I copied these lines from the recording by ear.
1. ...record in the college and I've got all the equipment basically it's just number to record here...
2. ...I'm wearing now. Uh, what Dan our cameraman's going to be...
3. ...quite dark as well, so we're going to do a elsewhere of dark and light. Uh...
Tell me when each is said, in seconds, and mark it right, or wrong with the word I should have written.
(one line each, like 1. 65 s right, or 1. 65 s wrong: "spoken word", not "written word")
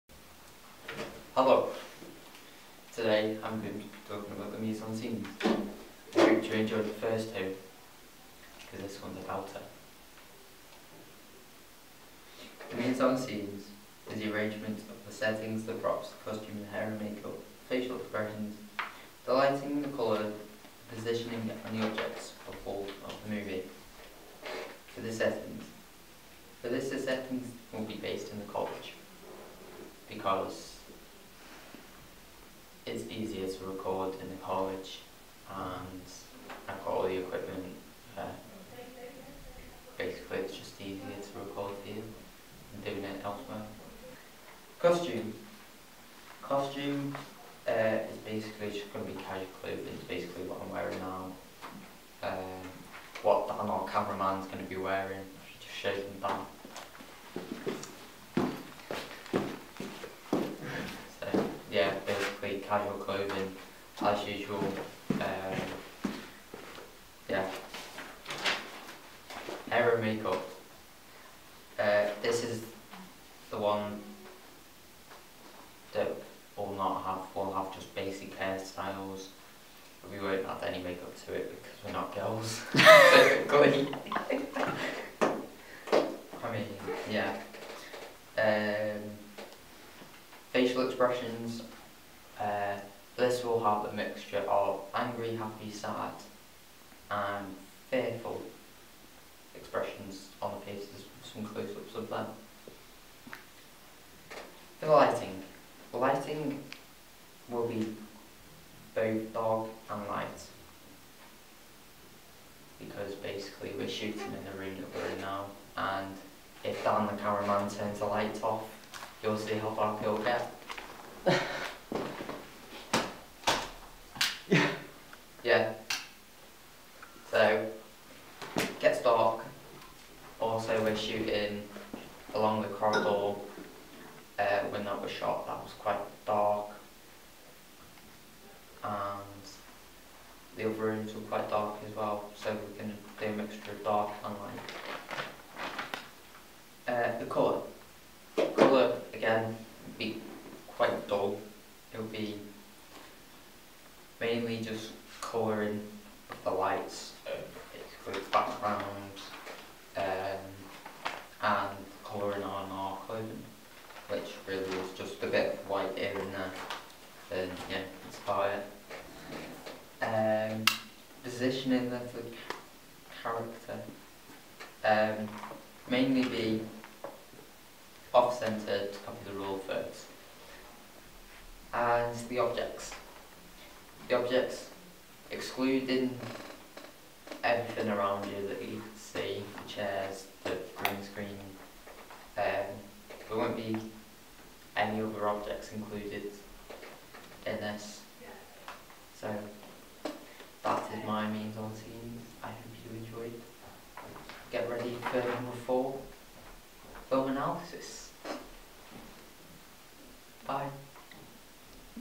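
1. 33 s wrong: "easier", not "number"
2. 50 s right
3. 141 s wrong: "mixture", not "elsewhere".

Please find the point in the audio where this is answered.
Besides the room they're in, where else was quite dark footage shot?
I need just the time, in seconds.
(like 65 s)
132 s.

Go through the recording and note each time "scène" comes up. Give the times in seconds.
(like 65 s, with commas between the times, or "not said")
4 s, 13 s, 201 s.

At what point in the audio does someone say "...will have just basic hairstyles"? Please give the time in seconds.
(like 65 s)
77 s.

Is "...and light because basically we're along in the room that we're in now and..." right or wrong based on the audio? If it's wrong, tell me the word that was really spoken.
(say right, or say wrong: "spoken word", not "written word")
wrong: "shooting", not "along".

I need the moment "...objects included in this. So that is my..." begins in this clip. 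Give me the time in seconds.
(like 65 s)
195 s.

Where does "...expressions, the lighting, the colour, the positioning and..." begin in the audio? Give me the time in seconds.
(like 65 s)
17 s.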